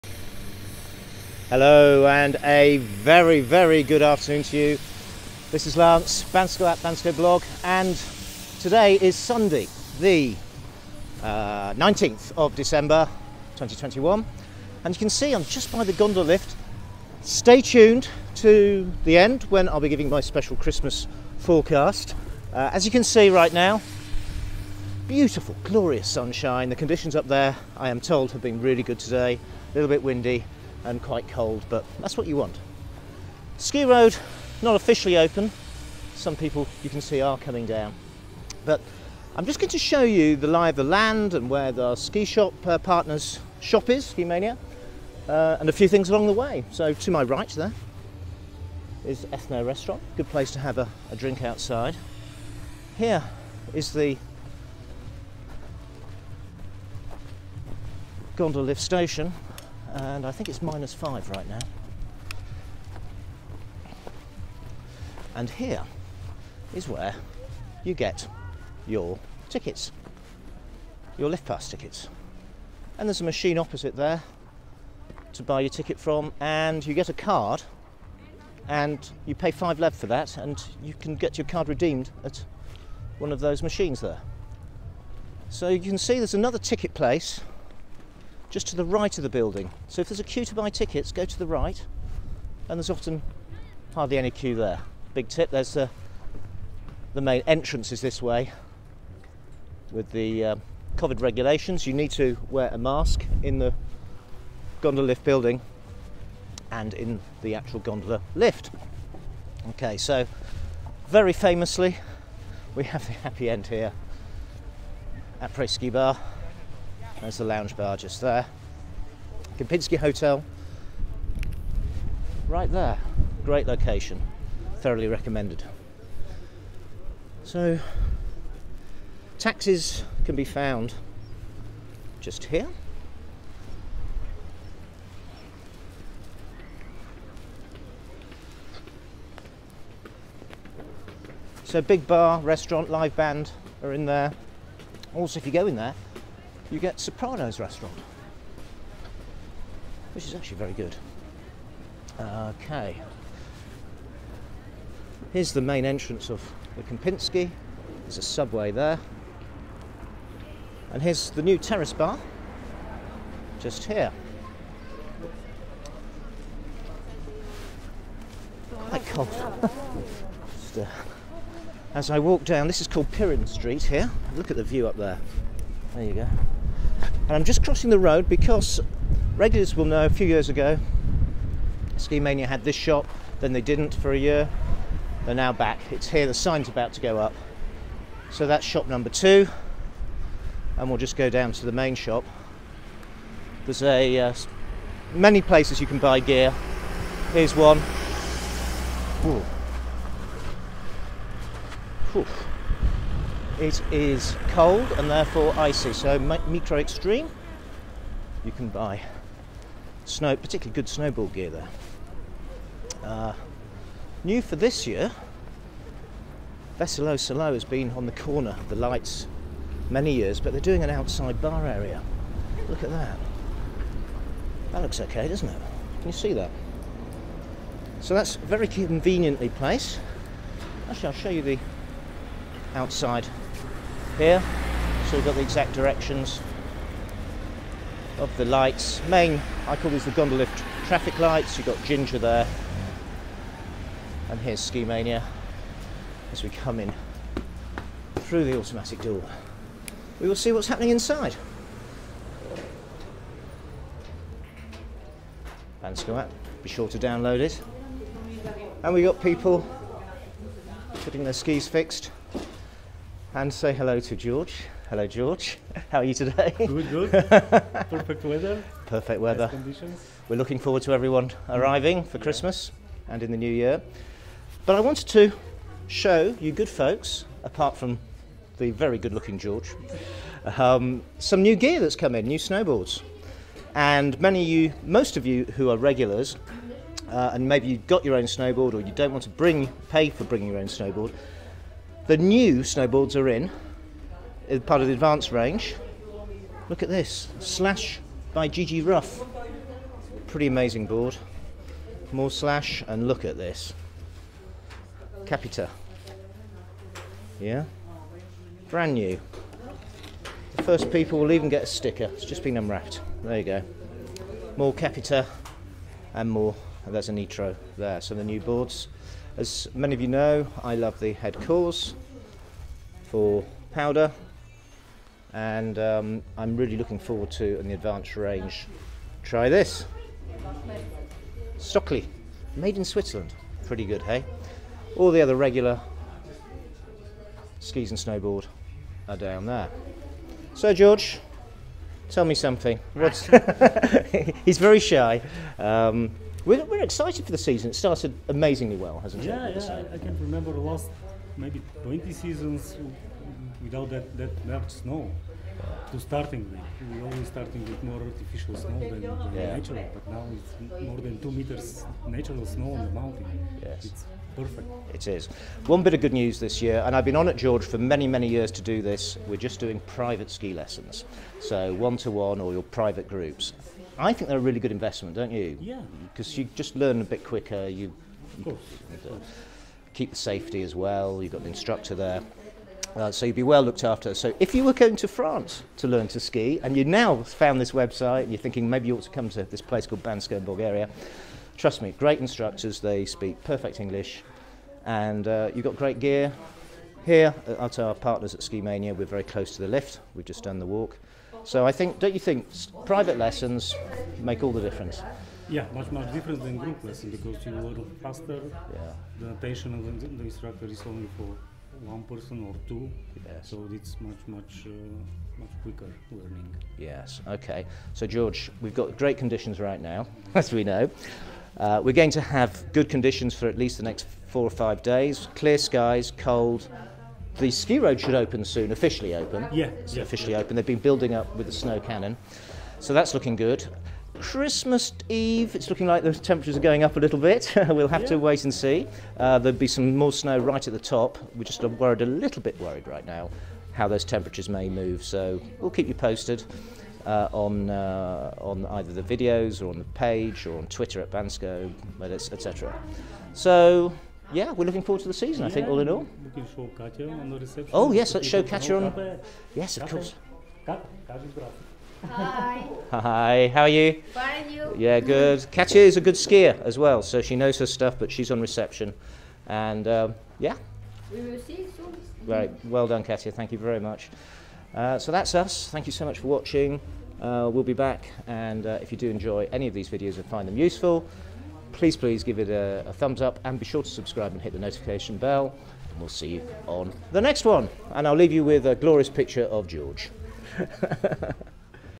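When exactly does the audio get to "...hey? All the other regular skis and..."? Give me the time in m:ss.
5:34.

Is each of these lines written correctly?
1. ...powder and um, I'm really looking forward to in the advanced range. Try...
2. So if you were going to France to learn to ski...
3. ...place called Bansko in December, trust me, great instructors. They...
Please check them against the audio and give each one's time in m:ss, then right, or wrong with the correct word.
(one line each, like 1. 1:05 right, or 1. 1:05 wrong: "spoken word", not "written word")
1. 5:23 right
2. 6:24 right
3. 6:29 wrong: "Bulgaria", not "December".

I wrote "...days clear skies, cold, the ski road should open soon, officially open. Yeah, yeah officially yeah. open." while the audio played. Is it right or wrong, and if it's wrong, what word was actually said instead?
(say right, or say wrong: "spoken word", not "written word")
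right.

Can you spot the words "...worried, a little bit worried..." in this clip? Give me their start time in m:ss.
7:21.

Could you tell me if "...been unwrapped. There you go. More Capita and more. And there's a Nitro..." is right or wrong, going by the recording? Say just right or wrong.
right.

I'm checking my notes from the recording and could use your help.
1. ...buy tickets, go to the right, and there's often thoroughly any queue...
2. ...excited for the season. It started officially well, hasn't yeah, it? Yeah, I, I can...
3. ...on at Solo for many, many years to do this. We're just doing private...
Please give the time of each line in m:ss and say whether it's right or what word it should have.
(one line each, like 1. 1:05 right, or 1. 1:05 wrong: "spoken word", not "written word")
1. 1:30 wrong: "hardly", not "thoroughly"
2. 5:46 wrong: "amazingly", not "officially"
3. 6:07 wrong: "George", not "Solo".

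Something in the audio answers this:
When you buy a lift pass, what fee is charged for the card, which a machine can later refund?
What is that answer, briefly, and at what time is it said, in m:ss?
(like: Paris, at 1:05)
5 lev, at 1:19.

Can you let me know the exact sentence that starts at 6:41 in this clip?
So I think, don't you think, private lessons make all the difference?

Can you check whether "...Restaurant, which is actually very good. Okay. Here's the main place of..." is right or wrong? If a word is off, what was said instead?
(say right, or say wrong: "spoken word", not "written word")
wrong: "entrance", not "place".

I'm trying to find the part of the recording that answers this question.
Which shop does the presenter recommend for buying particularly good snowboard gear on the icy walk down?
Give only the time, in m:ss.
3:26.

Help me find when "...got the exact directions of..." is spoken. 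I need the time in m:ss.
3:55.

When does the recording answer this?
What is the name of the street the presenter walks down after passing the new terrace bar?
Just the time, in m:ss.
2:53.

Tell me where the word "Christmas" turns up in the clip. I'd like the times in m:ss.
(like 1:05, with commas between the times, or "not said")
0:20, 4:32, 7:14.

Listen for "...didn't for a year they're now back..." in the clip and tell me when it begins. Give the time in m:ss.
3:03.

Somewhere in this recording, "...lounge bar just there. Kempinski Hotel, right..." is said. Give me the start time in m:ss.
1:57.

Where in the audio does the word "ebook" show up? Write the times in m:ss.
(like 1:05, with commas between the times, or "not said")
not said.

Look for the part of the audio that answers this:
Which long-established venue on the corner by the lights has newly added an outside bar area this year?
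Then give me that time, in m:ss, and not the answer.
3:36.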